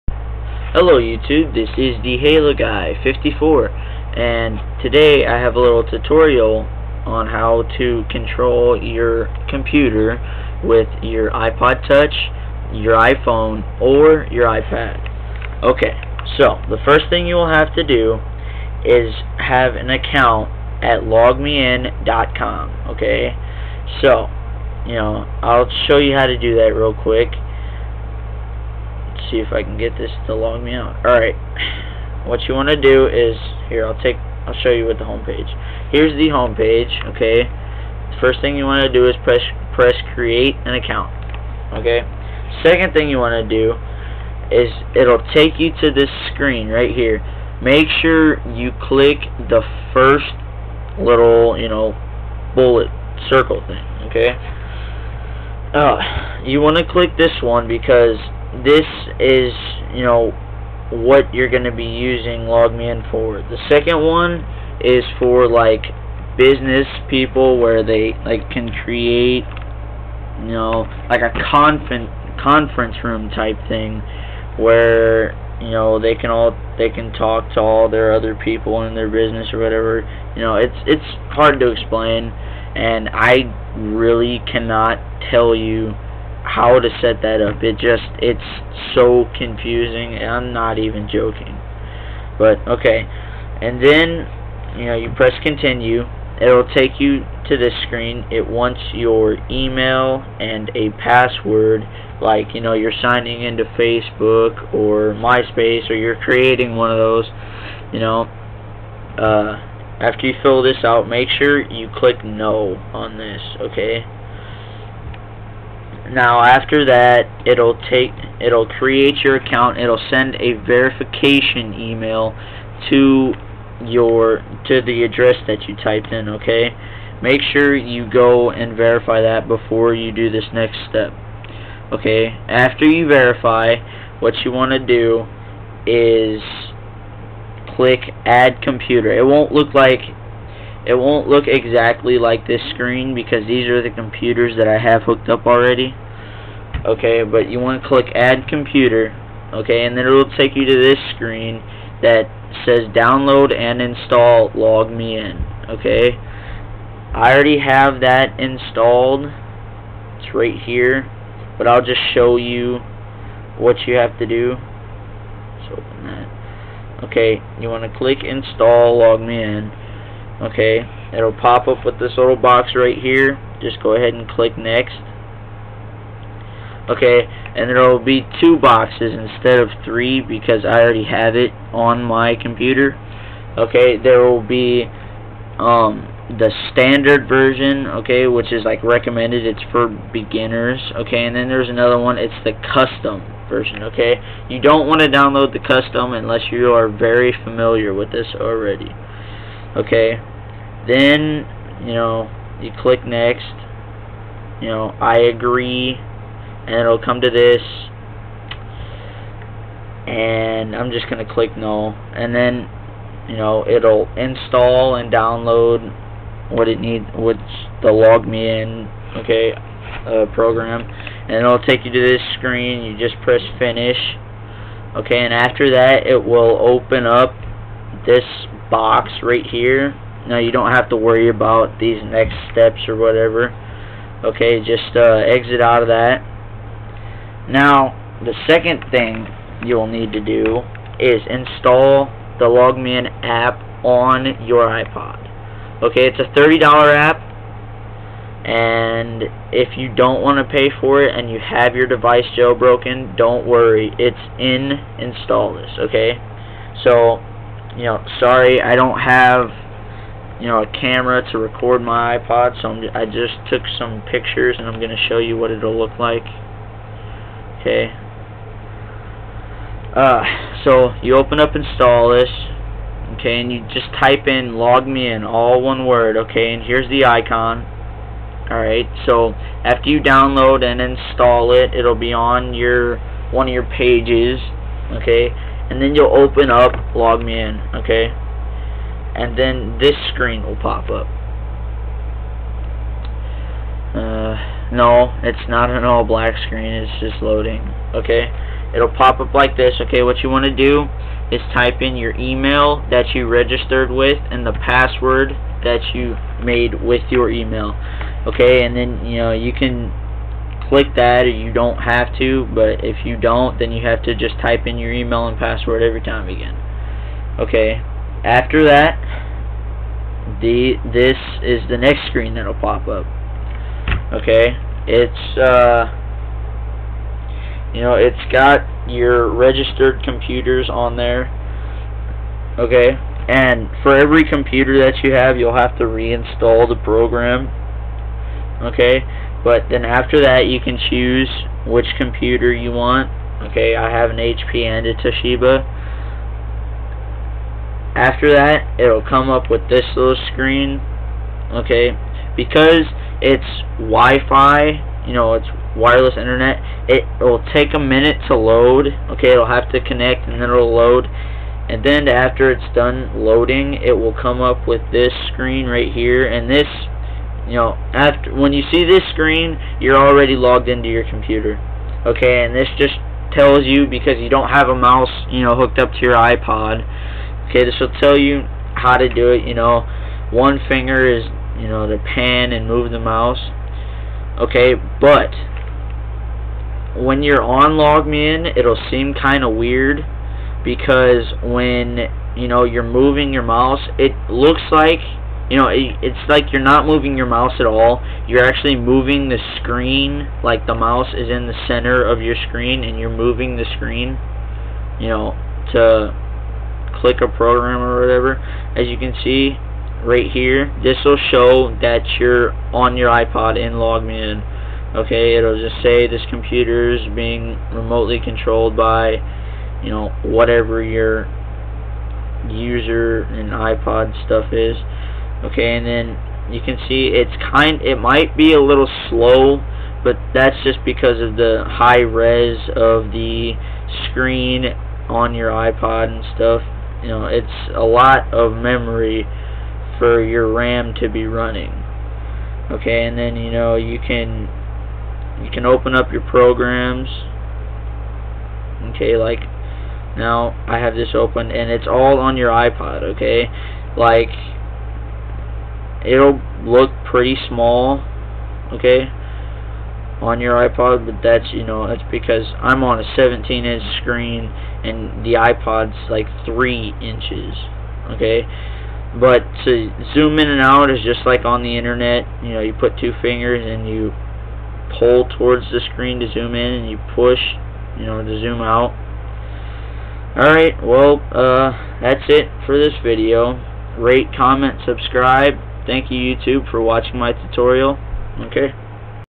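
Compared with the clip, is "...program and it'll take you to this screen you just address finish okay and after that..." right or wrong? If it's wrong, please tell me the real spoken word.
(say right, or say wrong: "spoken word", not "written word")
wrong: "press", not "address".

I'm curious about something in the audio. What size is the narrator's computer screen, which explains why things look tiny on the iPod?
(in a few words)
17-inch.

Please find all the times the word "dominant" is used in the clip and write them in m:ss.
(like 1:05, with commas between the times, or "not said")
not said.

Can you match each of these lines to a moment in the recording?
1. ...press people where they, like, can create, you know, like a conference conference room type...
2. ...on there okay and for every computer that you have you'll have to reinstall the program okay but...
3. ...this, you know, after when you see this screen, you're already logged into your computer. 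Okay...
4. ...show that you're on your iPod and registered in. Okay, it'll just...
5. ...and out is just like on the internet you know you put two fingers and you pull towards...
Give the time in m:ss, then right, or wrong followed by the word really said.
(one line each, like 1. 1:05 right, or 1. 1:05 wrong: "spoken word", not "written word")
1. 1:06 wrong: "business", not "press"
2. 5:30 right
3. 6:06 right
4. 6:51 wrong: "logged", not "registered"
5. 7:50 right.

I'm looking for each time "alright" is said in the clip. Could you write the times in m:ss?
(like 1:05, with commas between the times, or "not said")
0:31, 4:38, 8:00.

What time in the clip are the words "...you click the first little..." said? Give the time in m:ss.
0:48.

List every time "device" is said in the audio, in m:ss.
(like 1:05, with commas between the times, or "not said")
4:11.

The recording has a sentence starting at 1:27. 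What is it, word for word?
It just, it's so confusing, I'm not even joking.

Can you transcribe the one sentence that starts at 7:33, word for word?
Like it'll look pretty small, okay?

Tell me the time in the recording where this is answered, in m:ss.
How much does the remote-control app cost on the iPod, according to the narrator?
4:06.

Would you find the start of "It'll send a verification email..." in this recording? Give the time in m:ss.
1:59.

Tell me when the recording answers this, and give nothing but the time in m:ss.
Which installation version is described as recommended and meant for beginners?
3:06.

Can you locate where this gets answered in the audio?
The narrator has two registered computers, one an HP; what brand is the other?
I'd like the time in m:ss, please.
5:44.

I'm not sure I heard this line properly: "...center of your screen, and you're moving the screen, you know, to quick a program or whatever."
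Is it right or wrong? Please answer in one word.
wrong.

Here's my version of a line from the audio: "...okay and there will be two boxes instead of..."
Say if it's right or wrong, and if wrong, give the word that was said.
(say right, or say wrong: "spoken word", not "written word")
right.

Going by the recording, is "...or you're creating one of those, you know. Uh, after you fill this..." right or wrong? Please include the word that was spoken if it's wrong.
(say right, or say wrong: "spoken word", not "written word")
right.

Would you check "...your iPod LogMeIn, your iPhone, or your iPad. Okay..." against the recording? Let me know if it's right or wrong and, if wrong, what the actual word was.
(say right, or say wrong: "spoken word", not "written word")
wrong: "Touch", not "LogMeIn".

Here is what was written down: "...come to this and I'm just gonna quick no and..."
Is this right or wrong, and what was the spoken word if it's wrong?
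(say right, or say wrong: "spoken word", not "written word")
wrong: "click", not "quick".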